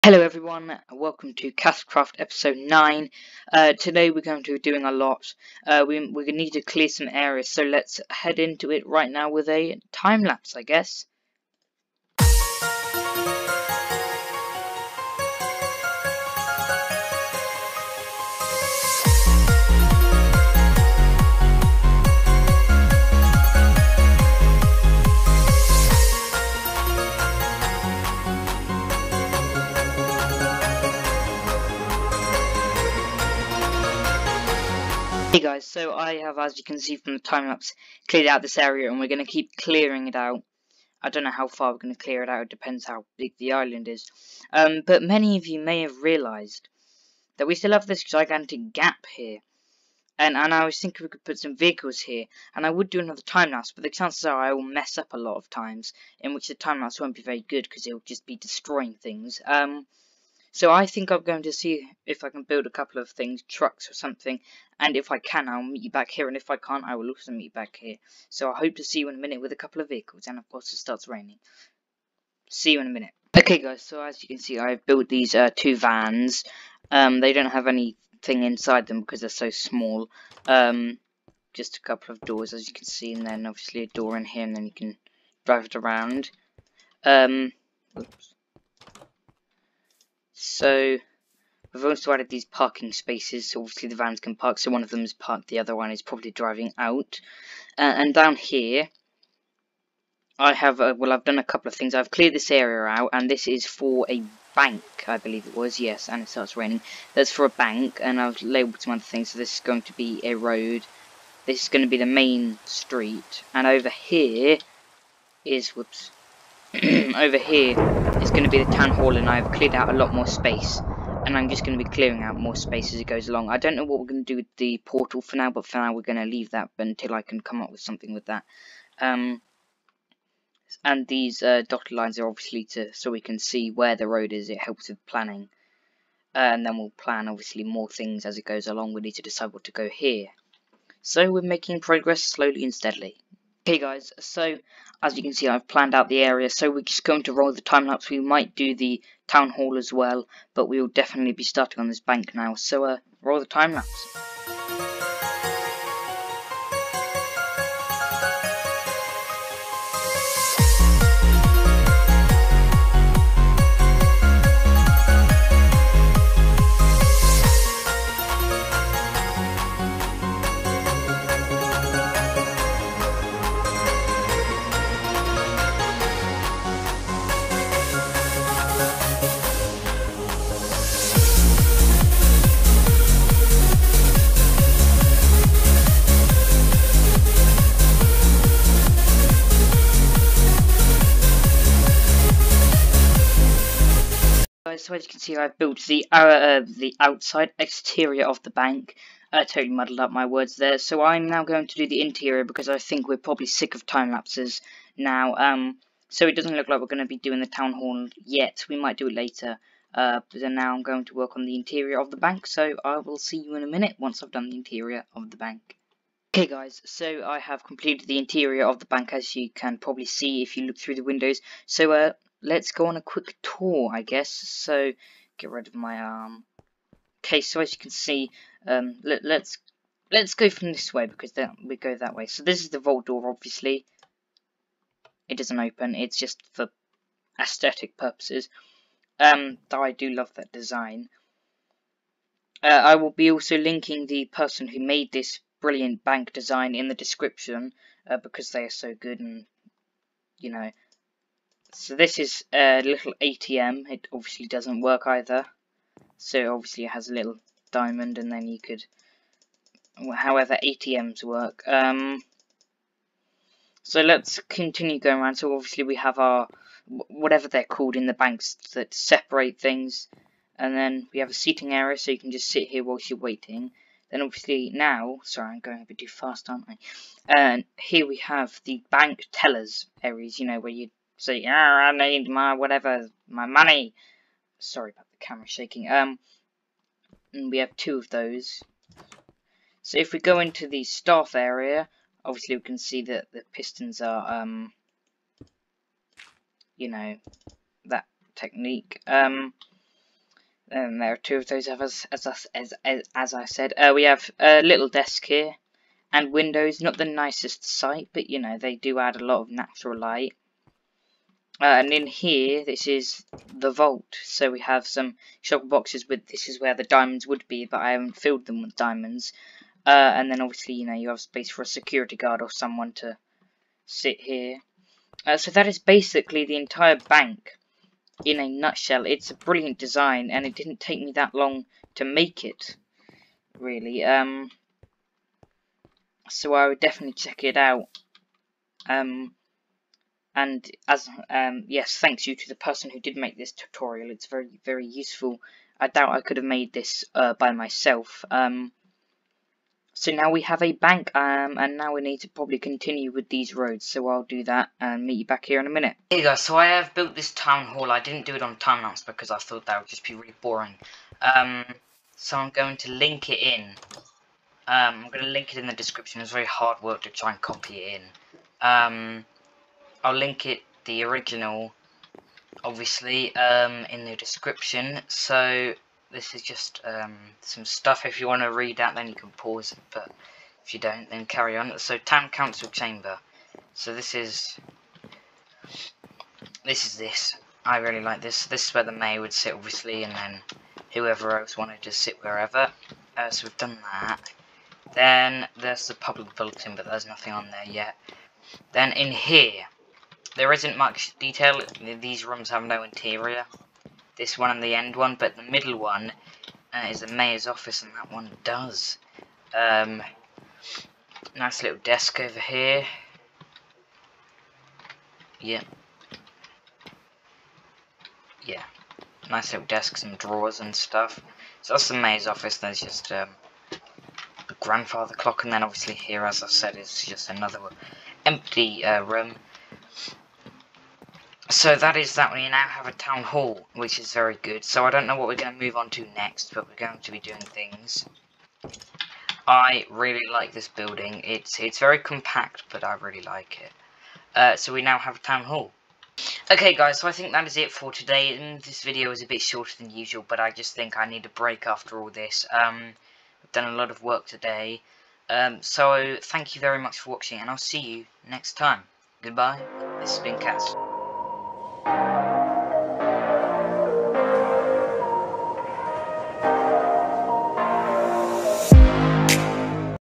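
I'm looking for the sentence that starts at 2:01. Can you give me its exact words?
And I'm just going to be clearing out more space as it goes along.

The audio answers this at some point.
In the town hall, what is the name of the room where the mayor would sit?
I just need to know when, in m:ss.
6:21.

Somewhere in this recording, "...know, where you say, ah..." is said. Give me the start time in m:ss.
4:40.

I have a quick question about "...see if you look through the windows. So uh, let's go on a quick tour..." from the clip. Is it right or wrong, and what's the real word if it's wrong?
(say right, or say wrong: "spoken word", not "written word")
right.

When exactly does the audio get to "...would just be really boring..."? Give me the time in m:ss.
5:59.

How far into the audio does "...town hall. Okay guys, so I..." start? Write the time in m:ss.
7:25.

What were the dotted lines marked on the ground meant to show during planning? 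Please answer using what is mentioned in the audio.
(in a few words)
where the road is.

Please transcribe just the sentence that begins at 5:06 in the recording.
Not the nicest sight, but you know they do add a lot of natural light.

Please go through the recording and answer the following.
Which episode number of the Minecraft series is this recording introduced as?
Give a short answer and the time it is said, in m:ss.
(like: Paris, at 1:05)
9, at 0:02.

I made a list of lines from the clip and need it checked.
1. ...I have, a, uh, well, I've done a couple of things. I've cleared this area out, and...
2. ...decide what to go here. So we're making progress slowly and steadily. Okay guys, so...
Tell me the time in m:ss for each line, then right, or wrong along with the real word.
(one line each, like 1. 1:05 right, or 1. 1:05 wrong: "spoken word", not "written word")
1. 1:40 right
2. 2:19 right.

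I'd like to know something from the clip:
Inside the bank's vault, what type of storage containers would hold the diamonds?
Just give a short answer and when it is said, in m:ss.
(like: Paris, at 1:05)
shulker boxes, at 5:15.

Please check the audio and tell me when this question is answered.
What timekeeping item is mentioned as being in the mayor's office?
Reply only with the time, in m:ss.
7:04.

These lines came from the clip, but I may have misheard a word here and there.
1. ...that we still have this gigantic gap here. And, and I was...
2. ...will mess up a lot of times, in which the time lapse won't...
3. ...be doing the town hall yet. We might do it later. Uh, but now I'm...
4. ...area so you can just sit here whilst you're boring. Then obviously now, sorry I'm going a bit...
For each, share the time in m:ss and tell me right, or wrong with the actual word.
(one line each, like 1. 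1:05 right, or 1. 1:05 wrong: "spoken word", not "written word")
1. 0:47 right
2. 0:54 right
3. 3:27 right
4. 4:31 wrong: "waiting", not "boring".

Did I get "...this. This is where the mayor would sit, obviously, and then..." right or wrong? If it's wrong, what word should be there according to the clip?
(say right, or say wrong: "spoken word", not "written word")
right.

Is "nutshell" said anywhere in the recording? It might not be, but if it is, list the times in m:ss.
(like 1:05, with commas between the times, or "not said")
5:28.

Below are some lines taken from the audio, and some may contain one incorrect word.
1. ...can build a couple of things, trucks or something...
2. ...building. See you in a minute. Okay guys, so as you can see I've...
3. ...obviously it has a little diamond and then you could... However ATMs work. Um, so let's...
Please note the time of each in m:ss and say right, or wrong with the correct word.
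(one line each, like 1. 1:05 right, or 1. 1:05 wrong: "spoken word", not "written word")
1. 1:02 right
2. 1:11 wrong: "raining", not "building"
3. 4:16 right.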